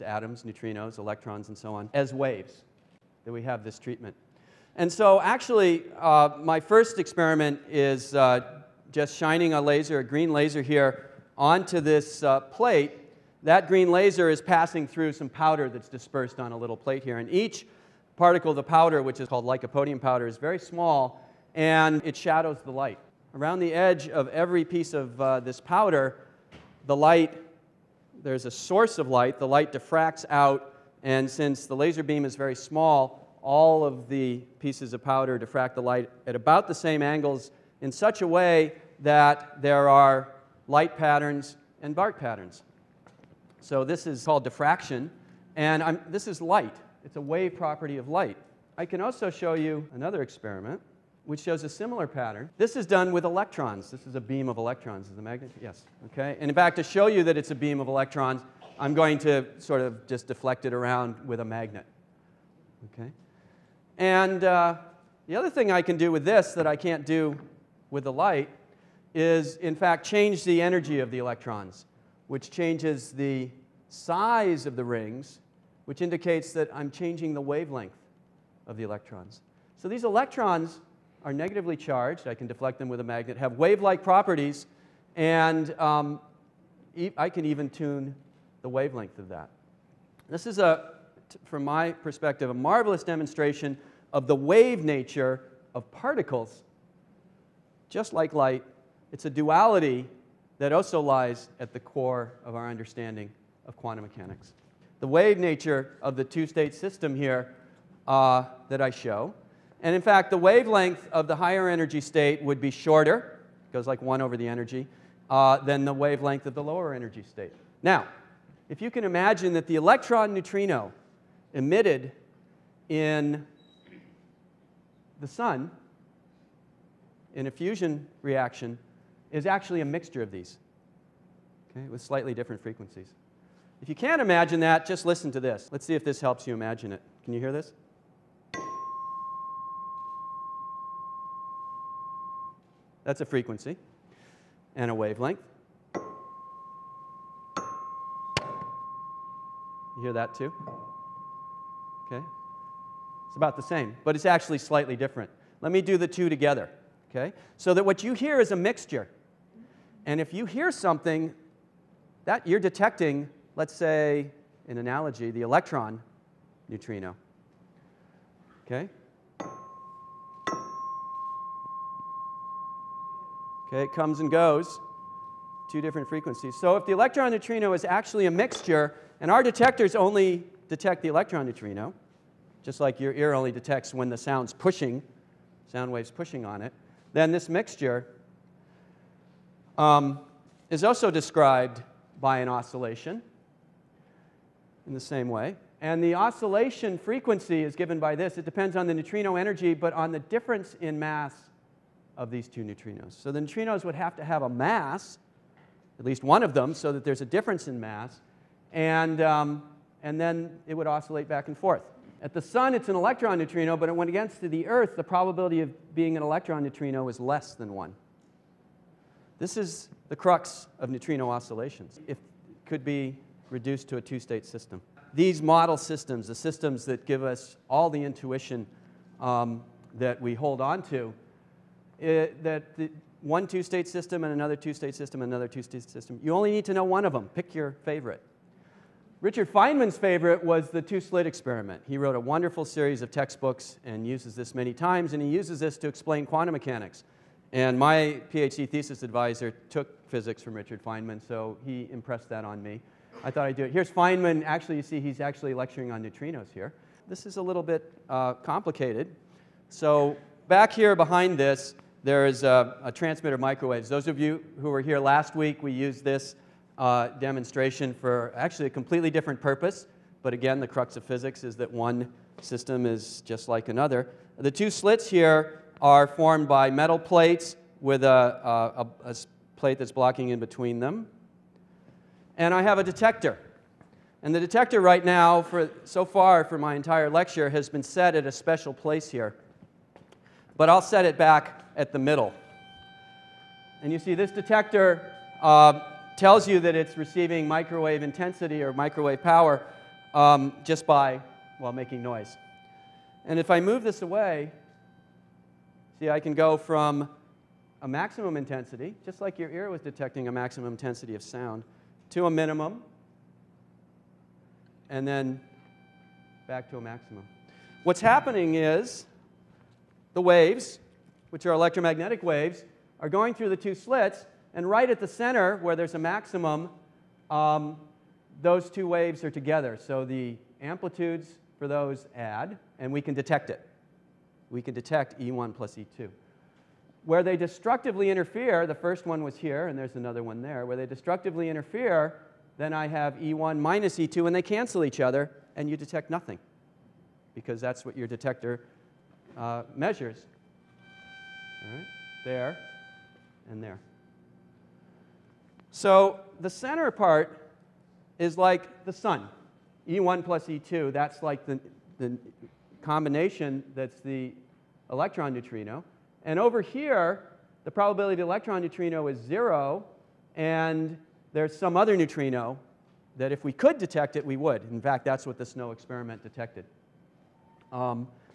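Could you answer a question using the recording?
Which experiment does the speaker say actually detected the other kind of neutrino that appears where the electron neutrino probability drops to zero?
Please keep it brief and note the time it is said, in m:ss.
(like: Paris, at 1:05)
SNO, at 6:15.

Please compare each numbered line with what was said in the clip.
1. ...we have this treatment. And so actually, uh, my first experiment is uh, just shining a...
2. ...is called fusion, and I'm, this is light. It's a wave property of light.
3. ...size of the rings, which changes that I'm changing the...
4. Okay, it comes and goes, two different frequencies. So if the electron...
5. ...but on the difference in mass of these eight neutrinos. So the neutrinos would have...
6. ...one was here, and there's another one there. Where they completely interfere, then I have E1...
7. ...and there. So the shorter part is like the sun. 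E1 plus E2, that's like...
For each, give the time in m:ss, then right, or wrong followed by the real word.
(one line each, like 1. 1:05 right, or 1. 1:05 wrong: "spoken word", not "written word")
1. 0:03 right
2. 0:44 wrong: "diffraction", not "fusion"
3. 1:13 wrong: "indicates", not "changes"
4. 2:53 right
5. 3:19 wrong: "two", not "eight"
6. 5:39 wrong: "destructively", not "completely"
7. 5:53 wrong: "center", not "shorter".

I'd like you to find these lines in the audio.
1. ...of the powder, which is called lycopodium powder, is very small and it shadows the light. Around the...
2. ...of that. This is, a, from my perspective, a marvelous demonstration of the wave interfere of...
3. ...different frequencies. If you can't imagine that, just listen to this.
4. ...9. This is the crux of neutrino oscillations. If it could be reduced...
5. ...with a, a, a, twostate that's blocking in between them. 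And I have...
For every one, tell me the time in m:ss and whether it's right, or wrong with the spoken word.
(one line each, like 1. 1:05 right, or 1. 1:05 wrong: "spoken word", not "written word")
1. 0:18 right
2. 1:29 wrong: "nature", not "interfere"
3. 2:12 right
4. 3:37 wrong: "1", not "9"
5. 4:37 wrong: "plate", not "twostate".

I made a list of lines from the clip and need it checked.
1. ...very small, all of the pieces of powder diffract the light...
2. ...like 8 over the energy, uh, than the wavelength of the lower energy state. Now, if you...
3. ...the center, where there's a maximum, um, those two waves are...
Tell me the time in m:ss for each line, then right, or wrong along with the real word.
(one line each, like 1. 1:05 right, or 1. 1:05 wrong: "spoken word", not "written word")
1. 0:32 right
2. 1:53 wrong: "1", not "8"
3. 5:24 right.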